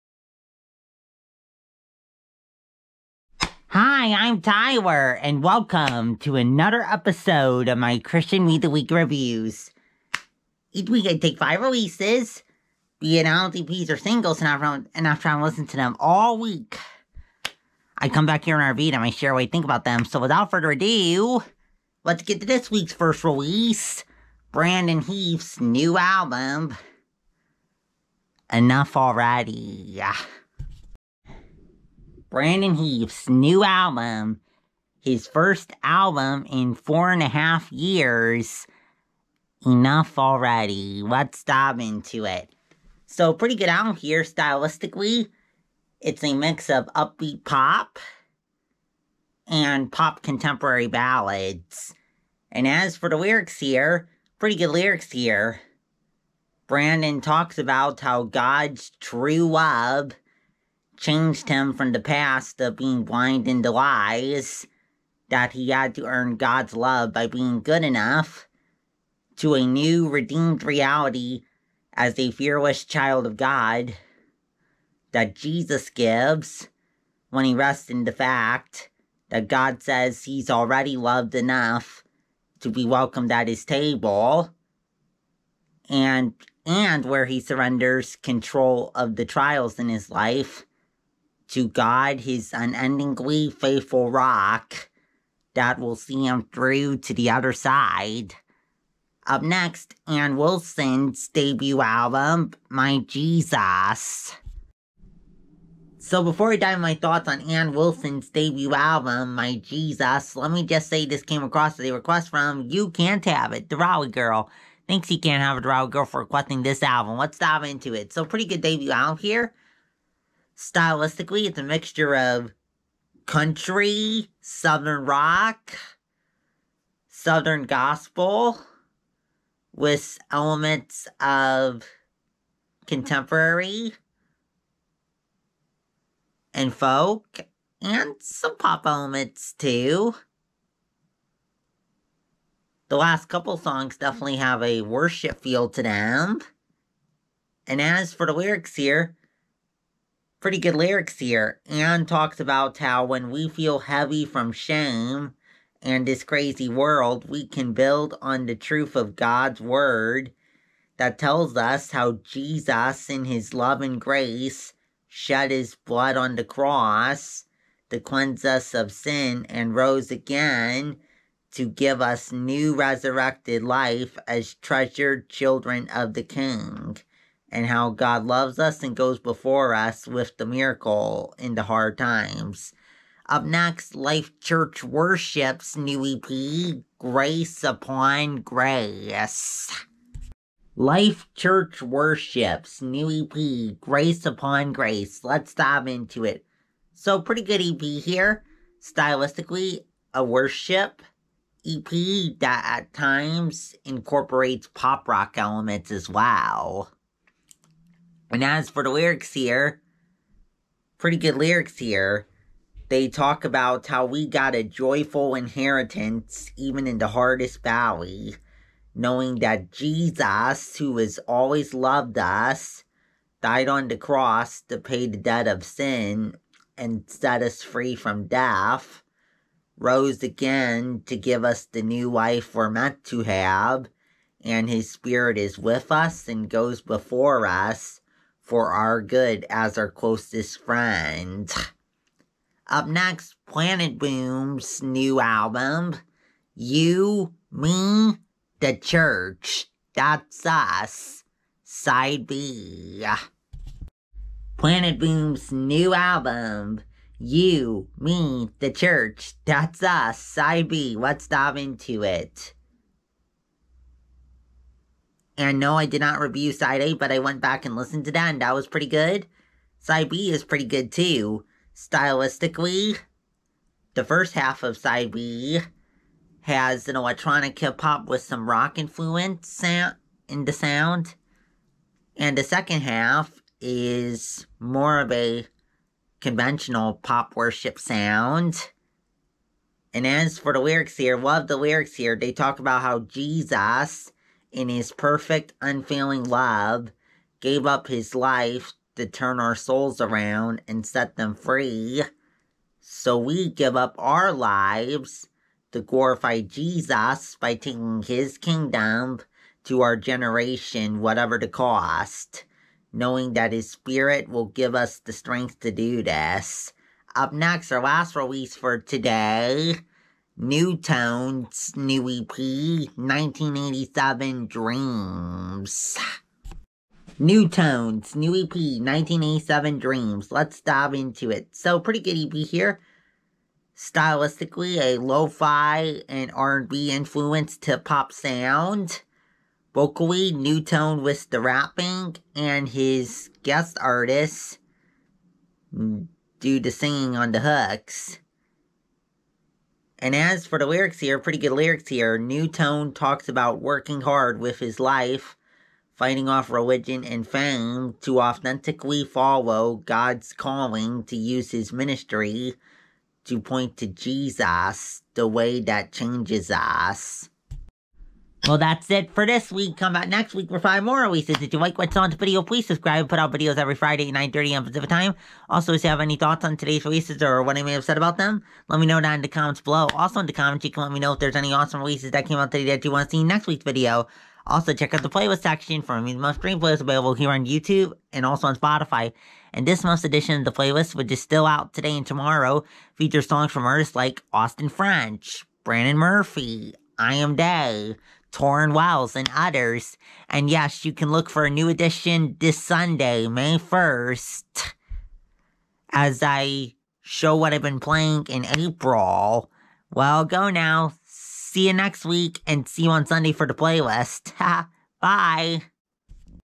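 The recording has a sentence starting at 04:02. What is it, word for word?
Up next, planetboom's new album, You, Me, the Church.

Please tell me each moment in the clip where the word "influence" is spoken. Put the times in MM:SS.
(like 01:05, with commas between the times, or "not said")
04:38, 05:36.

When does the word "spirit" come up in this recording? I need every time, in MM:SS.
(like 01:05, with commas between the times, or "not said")
03:54, 05:13.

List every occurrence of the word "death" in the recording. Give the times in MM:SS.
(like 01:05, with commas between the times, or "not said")
03:48.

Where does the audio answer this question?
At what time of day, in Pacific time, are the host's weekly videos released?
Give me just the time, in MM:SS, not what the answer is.
06:14.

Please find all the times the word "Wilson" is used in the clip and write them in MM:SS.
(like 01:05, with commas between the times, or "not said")
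01:40, 01:47.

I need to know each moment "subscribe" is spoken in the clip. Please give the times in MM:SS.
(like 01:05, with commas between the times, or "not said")
06:12.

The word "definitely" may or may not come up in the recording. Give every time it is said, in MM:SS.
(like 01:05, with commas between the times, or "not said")
02:23.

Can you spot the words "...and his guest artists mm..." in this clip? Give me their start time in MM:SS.
05:42.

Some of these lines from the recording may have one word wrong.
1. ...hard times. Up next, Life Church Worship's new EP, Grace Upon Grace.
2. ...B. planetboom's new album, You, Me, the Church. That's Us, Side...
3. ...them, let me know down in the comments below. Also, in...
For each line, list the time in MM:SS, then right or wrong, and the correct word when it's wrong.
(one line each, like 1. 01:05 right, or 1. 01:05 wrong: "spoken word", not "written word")
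1. 03:01 right
2. 04:12 right
3. 06:18 right.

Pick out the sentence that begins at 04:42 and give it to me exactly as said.
And the second half is more of a conventional pop worship sound.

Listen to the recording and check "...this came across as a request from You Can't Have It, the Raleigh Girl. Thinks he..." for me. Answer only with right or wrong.
right.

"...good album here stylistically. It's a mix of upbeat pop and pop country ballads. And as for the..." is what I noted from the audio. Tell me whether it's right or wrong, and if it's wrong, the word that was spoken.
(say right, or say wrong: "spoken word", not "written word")
wrong: "contemporary", not "country".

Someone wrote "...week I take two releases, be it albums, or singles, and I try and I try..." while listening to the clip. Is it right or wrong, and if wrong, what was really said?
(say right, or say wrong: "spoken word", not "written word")
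wrong: "five", not "two".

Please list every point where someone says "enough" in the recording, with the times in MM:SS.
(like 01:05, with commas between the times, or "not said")
00:28, 00:39, 01:07, 01:21.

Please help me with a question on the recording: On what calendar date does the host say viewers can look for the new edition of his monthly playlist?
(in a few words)
May 1.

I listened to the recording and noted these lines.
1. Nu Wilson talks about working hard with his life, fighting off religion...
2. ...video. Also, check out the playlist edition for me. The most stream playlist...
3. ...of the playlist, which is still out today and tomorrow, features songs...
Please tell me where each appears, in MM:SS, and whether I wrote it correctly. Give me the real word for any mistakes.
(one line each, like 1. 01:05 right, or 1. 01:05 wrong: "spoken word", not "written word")
1. 05:52 wrong: "Tone", not "Wilson"
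2. 06:23 wrong: "section", not "edition"
3. 06:30 right.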